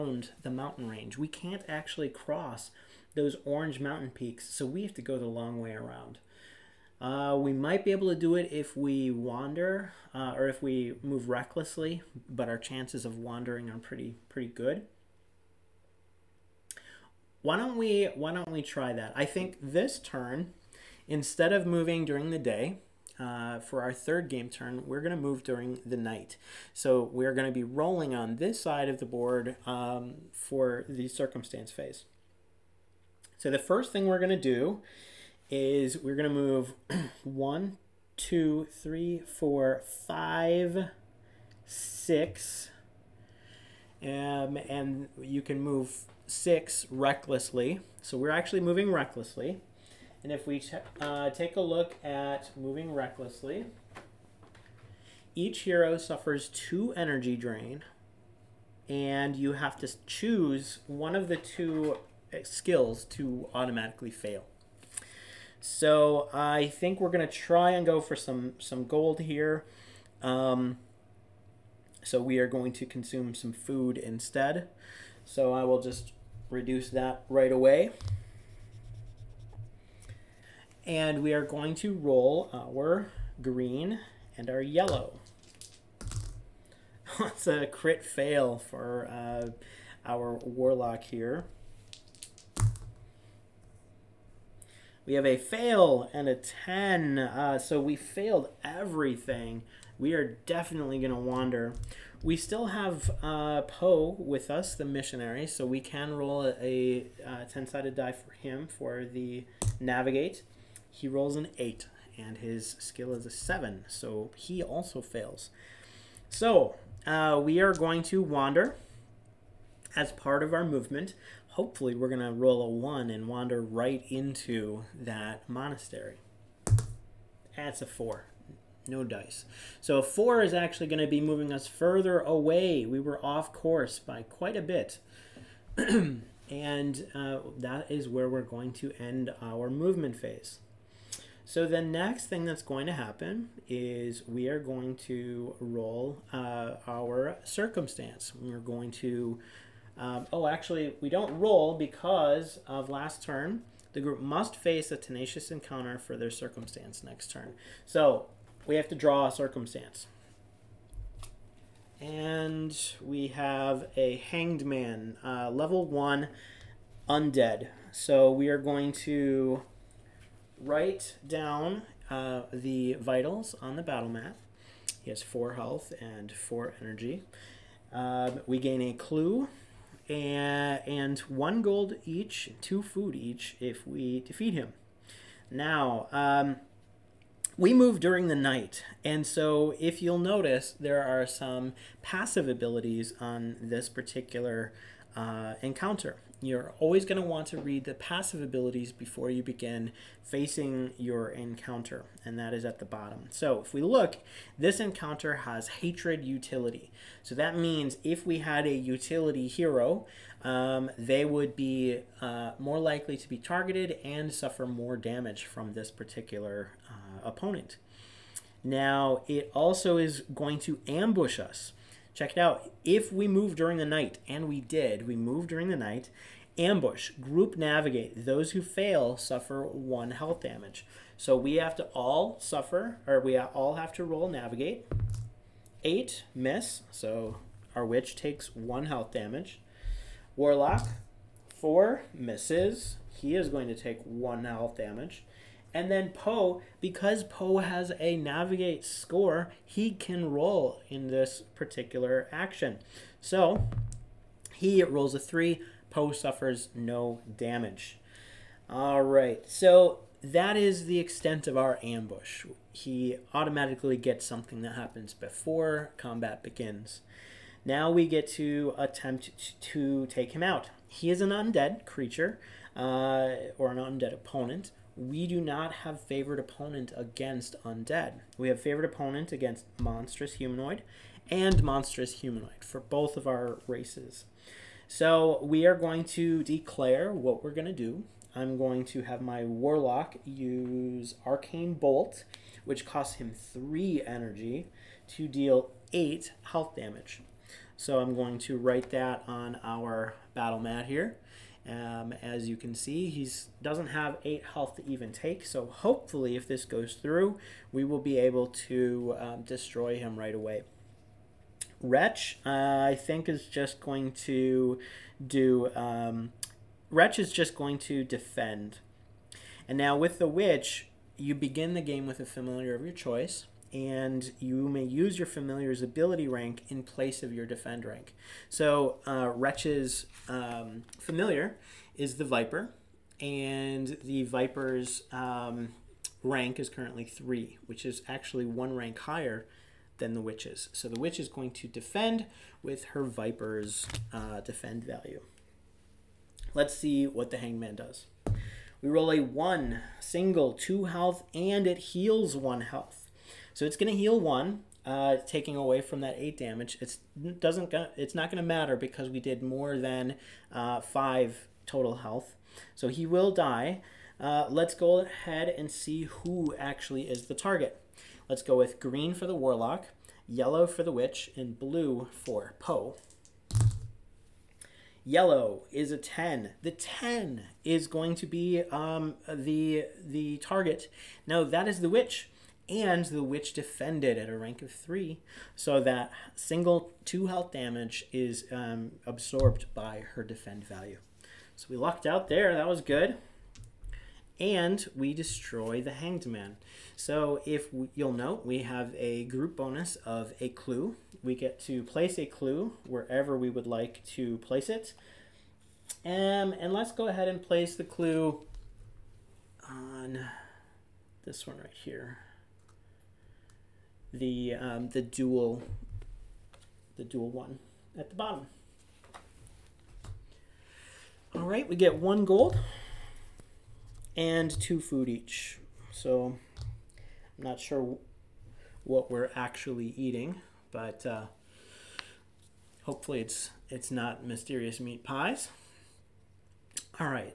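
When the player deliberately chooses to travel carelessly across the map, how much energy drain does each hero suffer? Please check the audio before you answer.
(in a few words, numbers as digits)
2.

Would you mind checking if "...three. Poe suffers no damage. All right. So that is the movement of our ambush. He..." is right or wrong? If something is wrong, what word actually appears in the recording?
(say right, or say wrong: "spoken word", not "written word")
wrong: "extent", not "movement".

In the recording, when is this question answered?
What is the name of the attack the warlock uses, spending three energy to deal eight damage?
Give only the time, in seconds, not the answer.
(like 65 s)
291 s.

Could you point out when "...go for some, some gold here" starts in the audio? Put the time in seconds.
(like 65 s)
67 s.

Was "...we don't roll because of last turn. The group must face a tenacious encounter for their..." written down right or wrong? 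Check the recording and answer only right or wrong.
right.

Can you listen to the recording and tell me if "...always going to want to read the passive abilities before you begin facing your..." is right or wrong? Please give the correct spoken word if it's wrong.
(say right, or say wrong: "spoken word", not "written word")
right.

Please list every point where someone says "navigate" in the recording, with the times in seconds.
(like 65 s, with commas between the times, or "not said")
109 s, 227 s, 234 s, 248 s.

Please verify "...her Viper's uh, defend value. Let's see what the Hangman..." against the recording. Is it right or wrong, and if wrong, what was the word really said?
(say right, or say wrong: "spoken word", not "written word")
right.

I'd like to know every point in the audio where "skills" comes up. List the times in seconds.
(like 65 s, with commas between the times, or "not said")
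62 s, 112 s.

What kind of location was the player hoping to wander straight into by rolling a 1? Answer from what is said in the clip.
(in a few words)
Monastery.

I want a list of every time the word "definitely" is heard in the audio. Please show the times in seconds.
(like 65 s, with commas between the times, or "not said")
100 s.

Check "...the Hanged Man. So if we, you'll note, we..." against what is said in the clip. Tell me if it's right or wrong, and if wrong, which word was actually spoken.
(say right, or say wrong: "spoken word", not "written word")
right.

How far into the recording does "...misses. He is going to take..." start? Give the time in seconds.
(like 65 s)
242 s.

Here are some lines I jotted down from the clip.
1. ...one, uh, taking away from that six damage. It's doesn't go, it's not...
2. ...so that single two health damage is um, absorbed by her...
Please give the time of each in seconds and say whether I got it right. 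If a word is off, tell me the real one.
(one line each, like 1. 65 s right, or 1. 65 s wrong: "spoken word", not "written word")
1. 354 s wrong: "eight", not "six"
2. 385 s right.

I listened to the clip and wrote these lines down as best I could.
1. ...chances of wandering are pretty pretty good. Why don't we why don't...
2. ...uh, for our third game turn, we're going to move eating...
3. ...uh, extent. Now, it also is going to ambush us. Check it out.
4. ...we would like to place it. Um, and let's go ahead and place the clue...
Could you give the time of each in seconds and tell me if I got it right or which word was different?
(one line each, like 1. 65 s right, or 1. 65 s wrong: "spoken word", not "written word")
1. 12 s right
2. 23 s wrong: "during", not "eating"
3. 216 s wrong: "opponent", not "extent"
4. 403 s right.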